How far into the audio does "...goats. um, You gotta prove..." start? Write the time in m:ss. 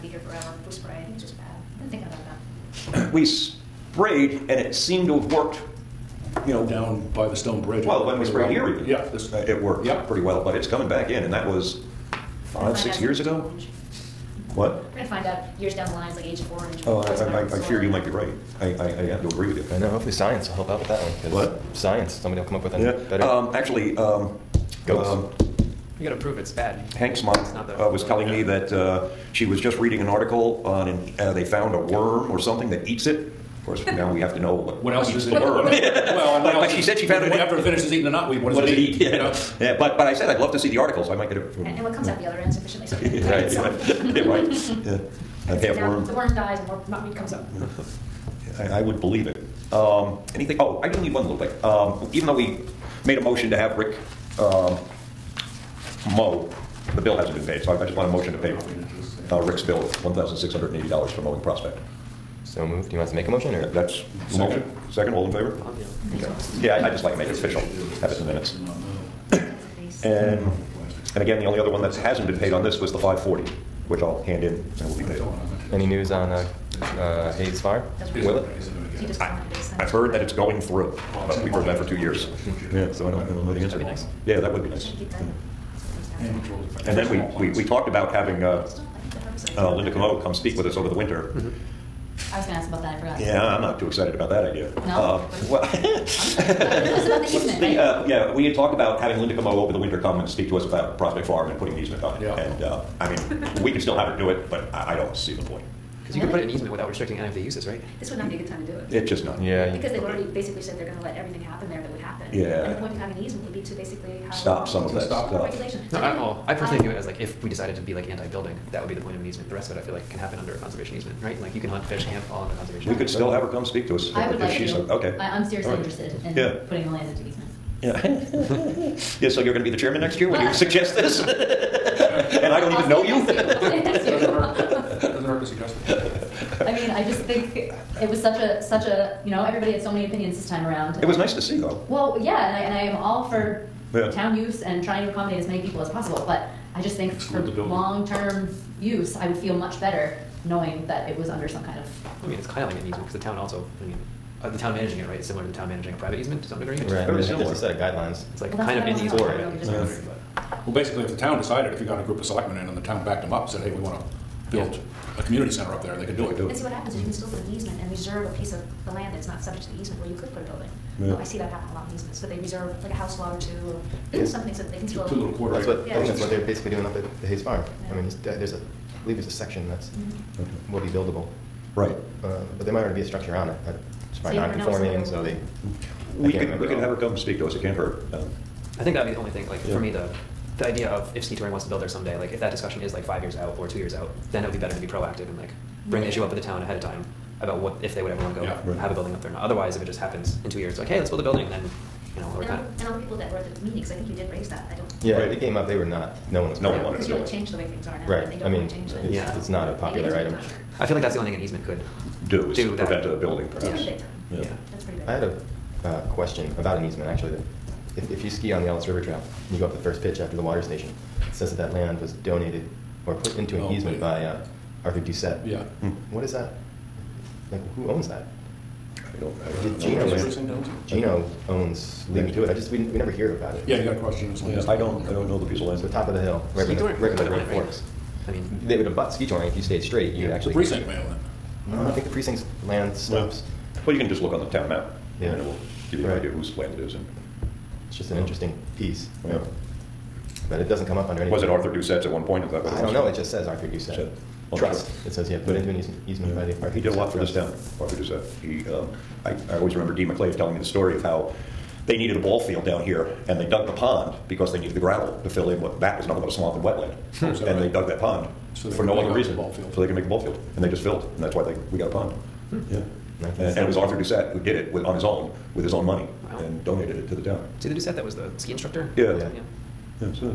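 0:24.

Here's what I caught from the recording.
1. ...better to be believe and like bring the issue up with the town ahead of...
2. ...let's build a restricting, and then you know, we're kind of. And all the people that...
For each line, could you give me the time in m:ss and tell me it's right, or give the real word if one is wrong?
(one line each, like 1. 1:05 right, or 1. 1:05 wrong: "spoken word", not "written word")
1. 3:14 wrong: "proactive", not "believe"
2. 3:20 wrong: "building", not "restricting".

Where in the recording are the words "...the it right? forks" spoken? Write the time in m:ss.
3:57.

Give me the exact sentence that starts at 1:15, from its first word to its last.
Any news on uh, uh, Hayes Farm?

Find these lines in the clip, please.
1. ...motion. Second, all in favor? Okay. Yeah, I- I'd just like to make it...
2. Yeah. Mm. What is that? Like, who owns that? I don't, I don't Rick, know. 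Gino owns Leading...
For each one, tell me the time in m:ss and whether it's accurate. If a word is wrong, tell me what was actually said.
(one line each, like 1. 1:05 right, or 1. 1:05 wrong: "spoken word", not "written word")
1. 1:04 right
2. 3:45 wrong: "Gino", not "Rick".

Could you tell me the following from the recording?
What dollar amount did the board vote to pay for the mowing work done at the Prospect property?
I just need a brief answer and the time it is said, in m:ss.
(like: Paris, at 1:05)
$1,680, at 1:00.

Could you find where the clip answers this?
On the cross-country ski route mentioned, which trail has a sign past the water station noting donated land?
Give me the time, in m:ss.
3:38.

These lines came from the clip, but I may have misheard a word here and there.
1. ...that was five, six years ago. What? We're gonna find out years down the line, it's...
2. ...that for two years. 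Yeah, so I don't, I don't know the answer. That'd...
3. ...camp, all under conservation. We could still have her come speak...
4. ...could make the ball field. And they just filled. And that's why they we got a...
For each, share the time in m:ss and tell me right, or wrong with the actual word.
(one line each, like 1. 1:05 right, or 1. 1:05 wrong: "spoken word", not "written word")
1. 0:11 right
2. 1:21 right
3. 2:02 right
4. 4:29 right.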